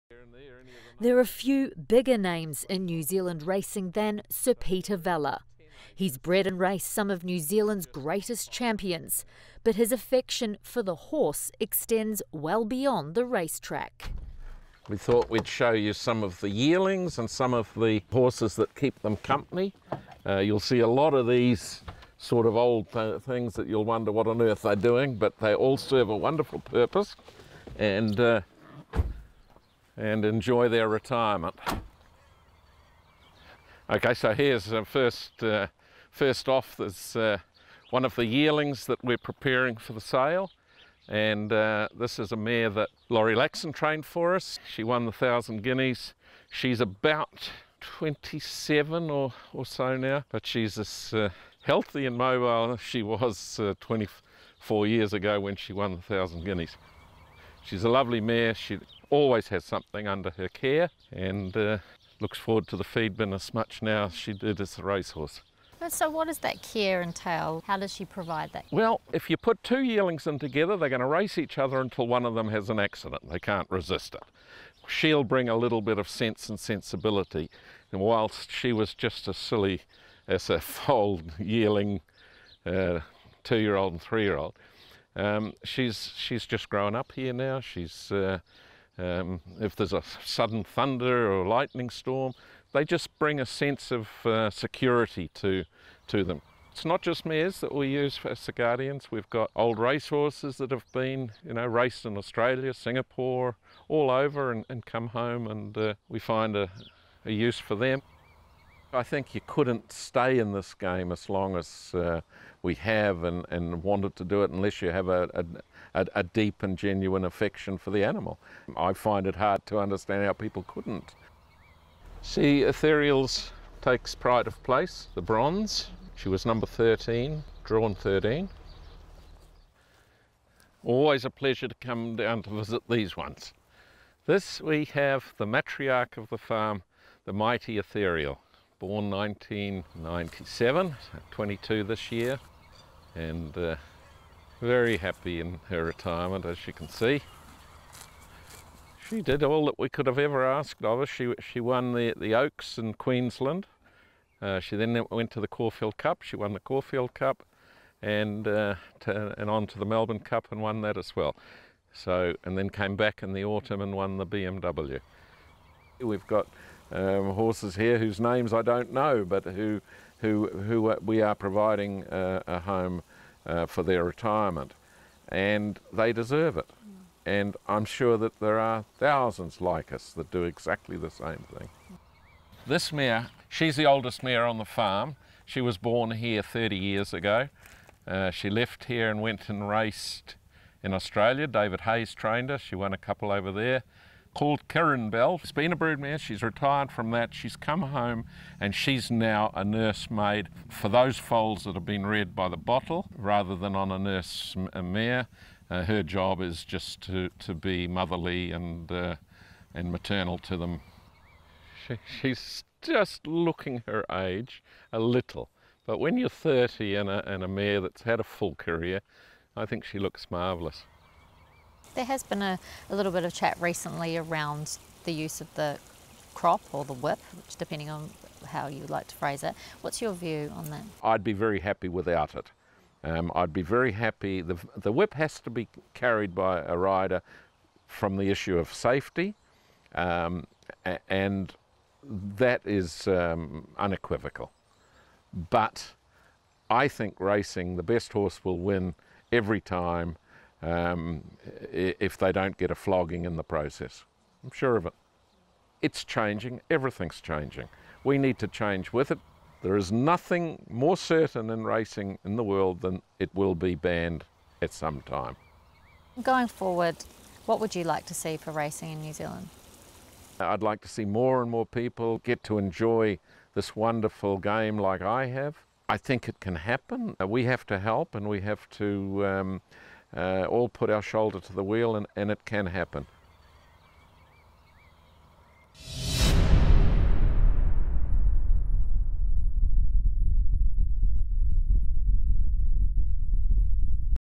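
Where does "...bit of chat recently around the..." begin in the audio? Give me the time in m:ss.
3:43.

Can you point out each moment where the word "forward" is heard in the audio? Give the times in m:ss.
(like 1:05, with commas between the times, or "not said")
1:02, 4:26.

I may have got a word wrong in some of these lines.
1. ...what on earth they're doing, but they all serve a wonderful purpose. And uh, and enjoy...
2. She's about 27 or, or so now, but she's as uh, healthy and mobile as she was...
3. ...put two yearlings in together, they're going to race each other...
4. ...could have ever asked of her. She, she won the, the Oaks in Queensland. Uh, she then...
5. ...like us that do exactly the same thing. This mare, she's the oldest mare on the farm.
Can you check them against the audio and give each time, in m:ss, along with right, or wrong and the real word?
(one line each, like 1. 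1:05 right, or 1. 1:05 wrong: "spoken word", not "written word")
1. 0:24 right
2. 0:46 right
3. 1:09 right
4. 2:29 right
5. 2:59 right.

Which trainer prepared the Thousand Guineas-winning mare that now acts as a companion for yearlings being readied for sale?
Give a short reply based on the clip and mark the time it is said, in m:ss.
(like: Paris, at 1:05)
Laurie Laxon, at 0:43.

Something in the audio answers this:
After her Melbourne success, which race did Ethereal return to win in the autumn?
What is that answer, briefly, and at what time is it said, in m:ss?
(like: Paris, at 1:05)
the BMW, at 2:44.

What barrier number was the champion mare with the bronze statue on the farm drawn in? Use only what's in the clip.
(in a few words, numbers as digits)
13.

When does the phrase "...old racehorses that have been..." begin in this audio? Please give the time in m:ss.
1:39.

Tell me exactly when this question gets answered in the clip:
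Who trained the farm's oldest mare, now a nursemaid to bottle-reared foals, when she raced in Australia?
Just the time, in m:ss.
3:11.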